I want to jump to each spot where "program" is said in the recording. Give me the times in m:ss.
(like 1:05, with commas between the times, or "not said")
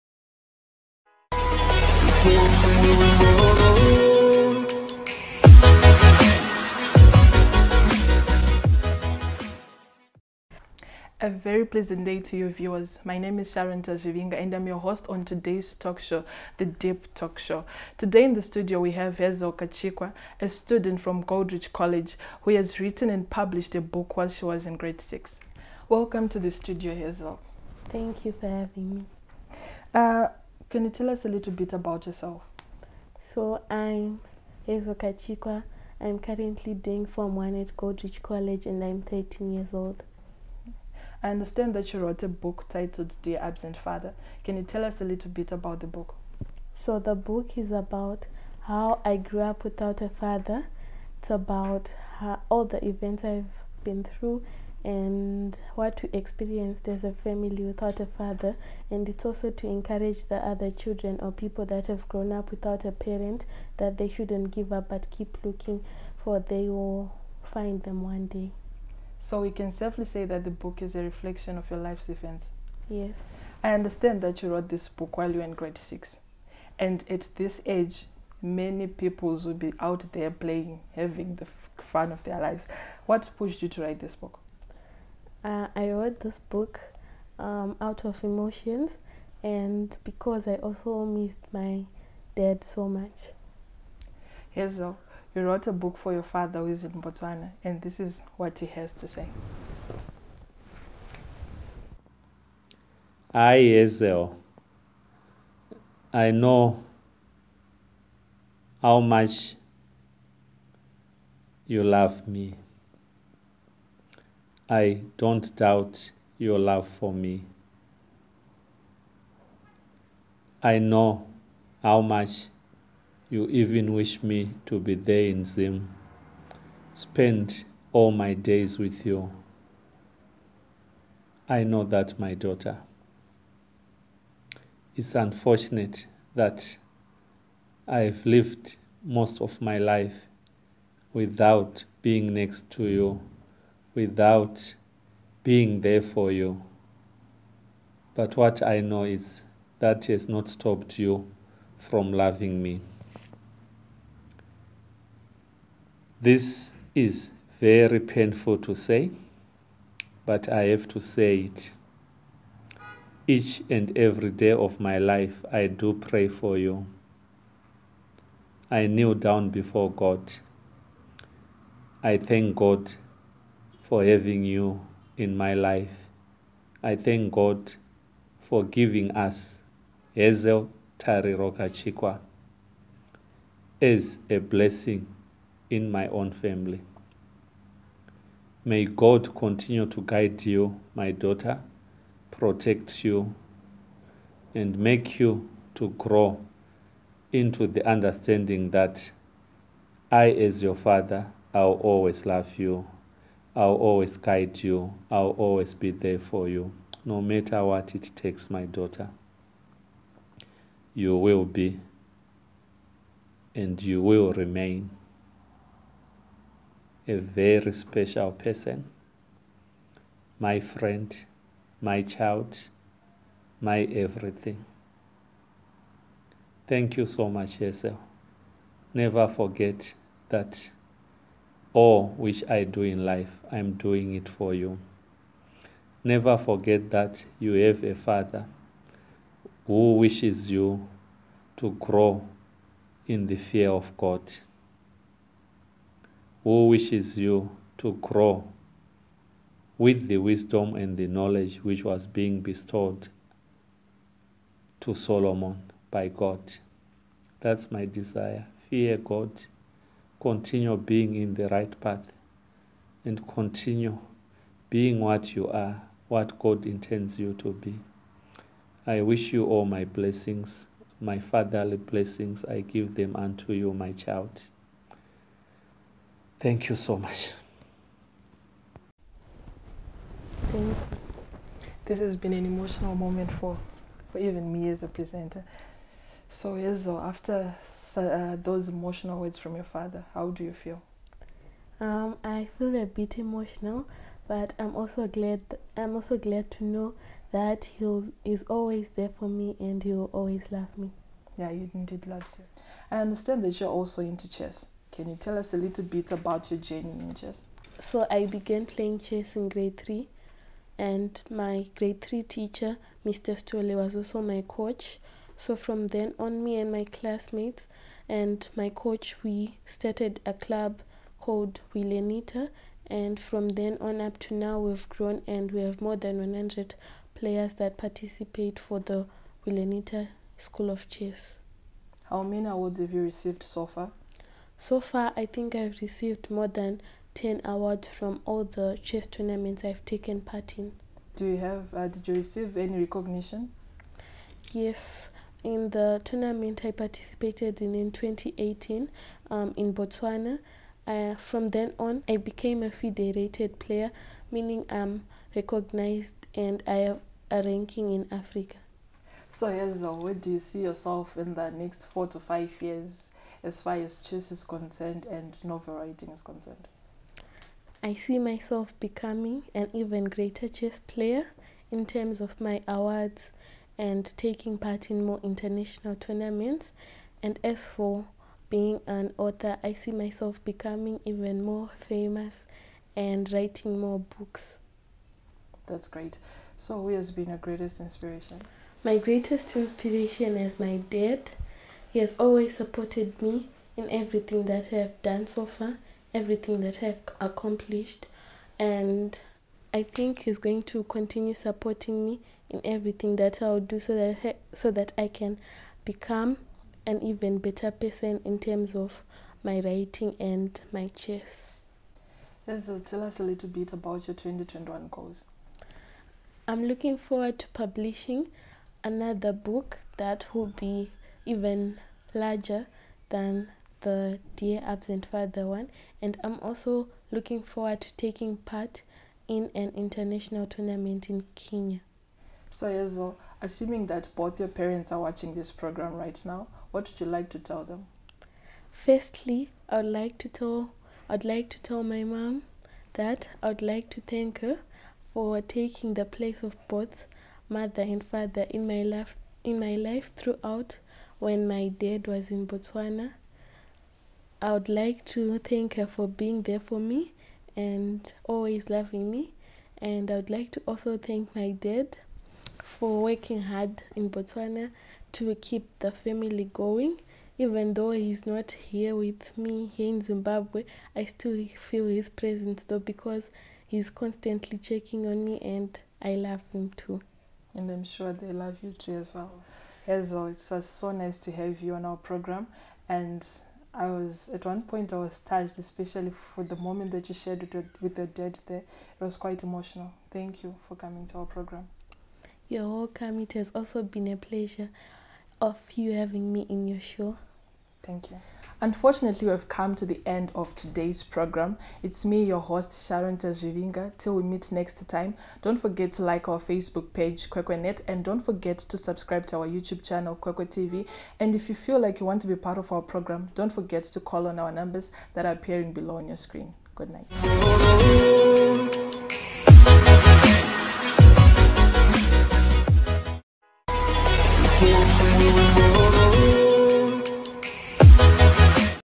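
7:15, 8:01, 8:11, 8:21, 8:32.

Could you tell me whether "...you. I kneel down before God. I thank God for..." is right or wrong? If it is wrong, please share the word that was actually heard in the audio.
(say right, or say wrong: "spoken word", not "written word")
right.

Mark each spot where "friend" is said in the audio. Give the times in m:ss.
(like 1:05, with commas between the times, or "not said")
3:40.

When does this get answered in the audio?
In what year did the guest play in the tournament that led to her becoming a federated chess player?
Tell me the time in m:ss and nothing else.
5:47.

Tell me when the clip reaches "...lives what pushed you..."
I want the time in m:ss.
1:22.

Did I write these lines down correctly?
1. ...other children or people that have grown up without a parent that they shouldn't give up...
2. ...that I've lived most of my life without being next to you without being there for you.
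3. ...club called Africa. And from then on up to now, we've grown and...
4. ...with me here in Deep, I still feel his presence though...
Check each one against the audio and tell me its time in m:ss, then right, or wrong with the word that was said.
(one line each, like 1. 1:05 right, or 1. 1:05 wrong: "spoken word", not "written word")
1. 1:00 right
2. 2:16 right
3. 5:20 wrong: "Wilenita", not "Africa"
4. 7:48 wrong: "Zimbabwe", not "Deep".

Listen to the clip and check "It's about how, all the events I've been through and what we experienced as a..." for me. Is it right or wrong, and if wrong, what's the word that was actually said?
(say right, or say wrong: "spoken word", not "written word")
right.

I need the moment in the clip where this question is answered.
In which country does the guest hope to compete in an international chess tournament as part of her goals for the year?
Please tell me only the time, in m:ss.
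7:11.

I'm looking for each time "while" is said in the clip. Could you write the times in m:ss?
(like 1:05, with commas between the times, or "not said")
0:24, 1:15.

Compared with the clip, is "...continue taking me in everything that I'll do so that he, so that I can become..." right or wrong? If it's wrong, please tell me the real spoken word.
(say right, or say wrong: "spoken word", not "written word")
wrong: "supporting", not "taking".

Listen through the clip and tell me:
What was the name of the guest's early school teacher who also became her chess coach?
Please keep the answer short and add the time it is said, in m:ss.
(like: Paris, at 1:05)
Mr. Stole, at 5:13.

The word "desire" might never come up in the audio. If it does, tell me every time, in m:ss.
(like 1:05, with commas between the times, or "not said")
4:17.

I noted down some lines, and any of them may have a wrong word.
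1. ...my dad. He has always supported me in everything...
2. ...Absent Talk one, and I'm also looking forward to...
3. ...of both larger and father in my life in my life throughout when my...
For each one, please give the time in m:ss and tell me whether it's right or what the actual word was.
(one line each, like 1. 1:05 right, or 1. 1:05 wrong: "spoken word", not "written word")
1. 6:30 right
2. 7:04 wrong: "Father", not "Talk"
3. 7:26 wrong: "mother", not "larger".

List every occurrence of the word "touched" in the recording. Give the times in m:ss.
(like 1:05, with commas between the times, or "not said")
8:05.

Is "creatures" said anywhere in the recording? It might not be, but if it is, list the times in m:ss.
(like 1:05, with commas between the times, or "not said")
not said.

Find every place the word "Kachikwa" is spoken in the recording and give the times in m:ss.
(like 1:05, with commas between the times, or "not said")
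0:19, 0:34, 3:01.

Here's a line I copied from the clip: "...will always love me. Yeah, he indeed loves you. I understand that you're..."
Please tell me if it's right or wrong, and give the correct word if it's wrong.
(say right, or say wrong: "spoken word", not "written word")
right.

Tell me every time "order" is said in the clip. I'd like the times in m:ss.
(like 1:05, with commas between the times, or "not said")
not said.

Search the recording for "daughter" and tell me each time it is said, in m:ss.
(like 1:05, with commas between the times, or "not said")
2:12, 3:11, 3:28.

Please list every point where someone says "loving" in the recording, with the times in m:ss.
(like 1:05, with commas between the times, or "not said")
2:32, 7:38.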